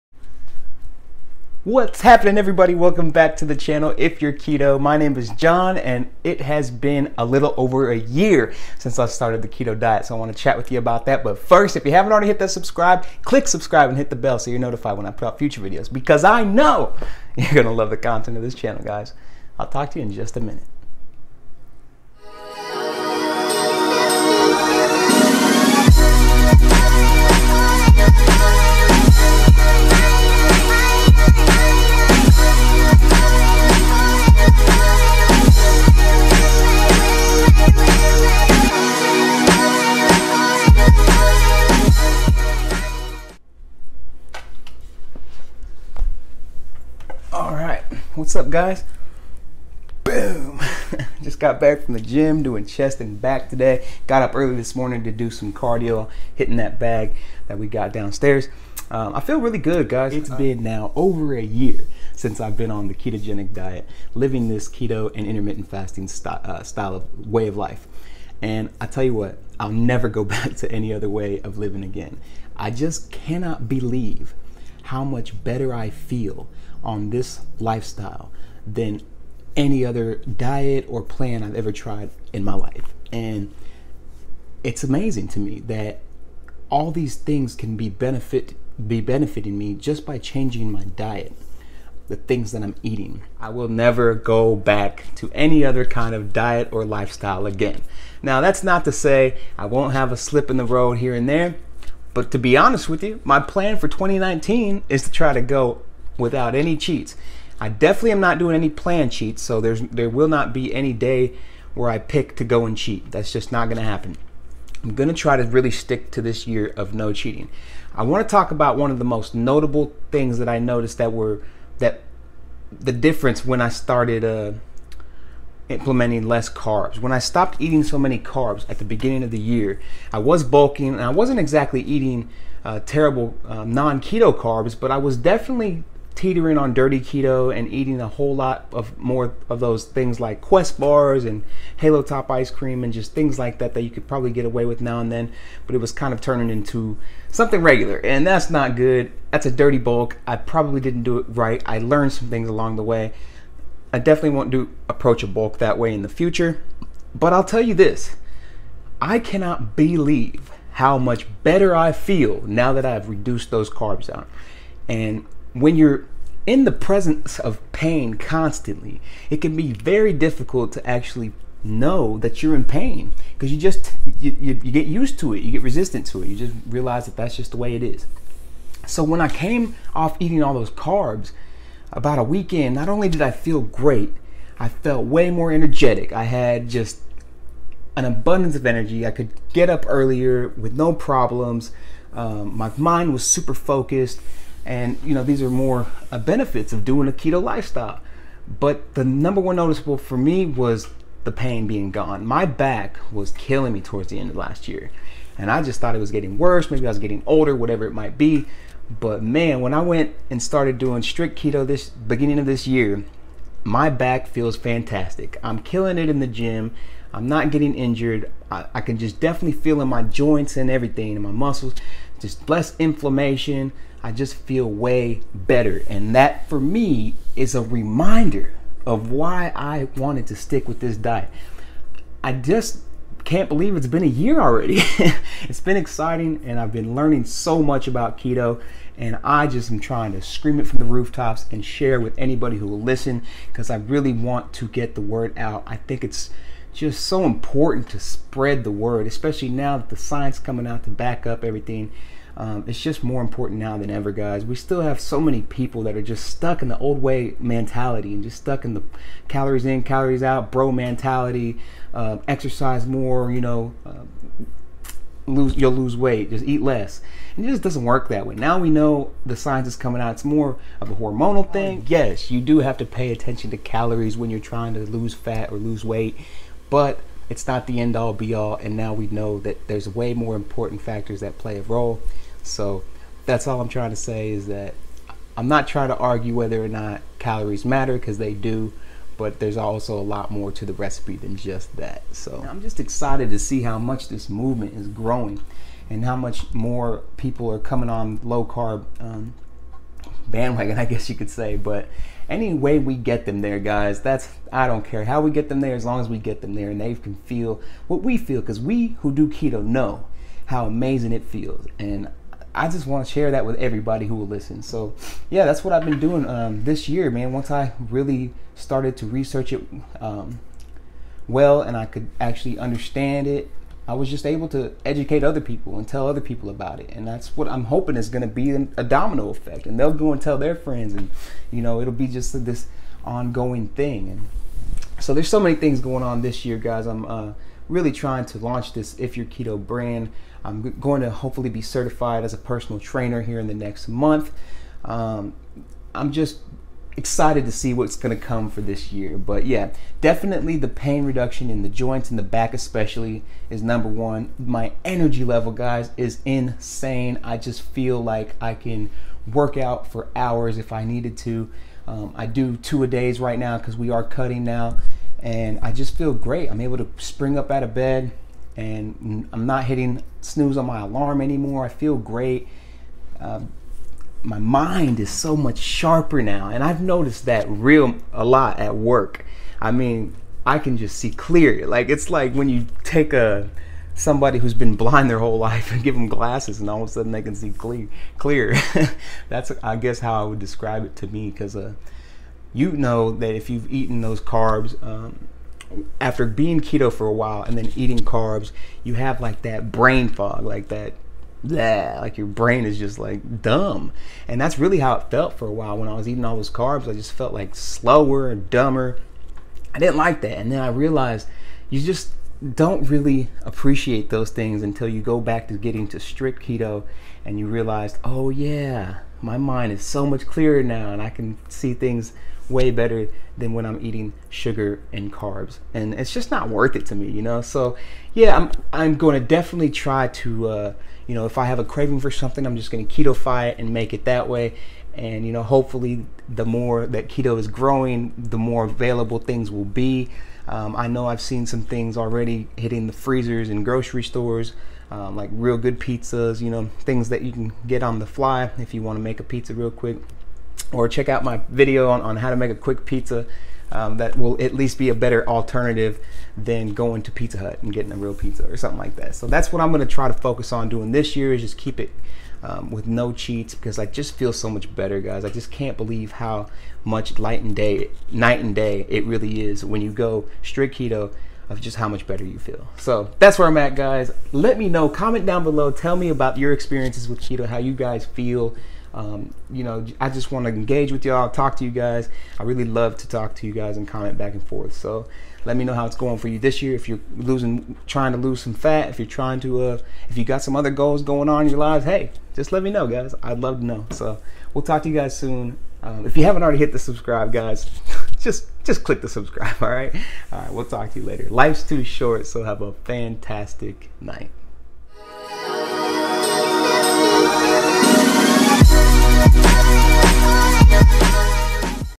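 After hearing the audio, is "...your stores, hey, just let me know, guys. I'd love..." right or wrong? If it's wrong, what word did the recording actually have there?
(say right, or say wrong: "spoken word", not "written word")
wrong: "lives", not "stores".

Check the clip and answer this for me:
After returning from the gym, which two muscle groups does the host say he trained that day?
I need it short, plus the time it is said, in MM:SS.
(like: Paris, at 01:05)
chest and back, at 00:52.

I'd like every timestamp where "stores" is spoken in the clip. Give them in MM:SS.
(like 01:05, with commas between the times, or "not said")
07:24.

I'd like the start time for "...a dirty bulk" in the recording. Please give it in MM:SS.
02:29.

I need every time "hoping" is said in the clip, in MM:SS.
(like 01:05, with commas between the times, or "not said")
05:27.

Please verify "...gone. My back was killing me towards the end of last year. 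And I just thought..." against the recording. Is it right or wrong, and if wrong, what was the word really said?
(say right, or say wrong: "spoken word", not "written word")
right.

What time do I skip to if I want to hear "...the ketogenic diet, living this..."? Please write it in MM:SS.
01:02.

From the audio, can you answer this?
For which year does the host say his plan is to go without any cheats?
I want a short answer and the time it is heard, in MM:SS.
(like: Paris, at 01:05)
2019, at 01:43.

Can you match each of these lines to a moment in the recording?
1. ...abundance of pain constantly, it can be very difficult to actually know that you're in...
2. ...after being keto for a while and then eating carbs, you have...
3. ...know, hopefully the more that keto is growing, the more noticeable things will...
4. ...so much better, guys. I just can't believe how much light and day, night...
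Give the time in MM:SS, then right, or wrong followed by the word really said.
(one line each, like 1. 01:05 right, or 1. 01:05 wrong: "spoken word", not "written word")
1. 02:46 wrong: "presence", not "abundance"
2. 06:35 right
3. 07:15 wrong: "available", not "noticeable"
4. 07:44 right.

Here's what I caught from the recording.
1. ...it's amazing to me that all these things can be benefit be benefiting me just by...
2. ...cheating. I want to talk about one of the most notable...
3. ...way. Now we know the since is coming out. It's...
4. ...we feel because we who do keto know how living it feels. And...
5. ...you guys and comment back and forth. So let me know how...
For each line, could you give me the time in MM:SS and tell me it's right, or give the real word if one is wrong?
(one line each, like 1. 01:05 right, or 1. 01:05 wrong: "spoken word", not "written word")
1. 01:24 right
2. 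01:57 right
3. 04:28 wrong: "science", not "since"
4. 05:08 wrong: "amazing", not "living"
5. 08:03 right.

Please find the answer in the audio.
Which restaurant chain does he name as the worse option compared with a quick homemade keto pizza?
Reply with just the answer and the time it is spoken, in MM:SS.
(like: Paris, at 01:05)
Pizza Hut, at 07:37.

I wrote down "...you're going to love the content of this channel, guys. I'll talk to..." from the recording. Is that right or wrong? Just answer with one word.
right.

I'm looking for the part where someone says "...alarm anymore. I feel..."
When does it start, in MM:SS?
06:10.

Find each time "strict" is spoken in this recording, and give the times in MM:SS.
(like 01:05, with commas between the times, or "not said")
03:31, 06:55, 07:50.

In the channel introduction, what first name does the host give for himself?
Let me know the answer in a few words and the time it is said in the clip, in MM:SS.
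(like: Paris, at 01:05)
John, at 00:05.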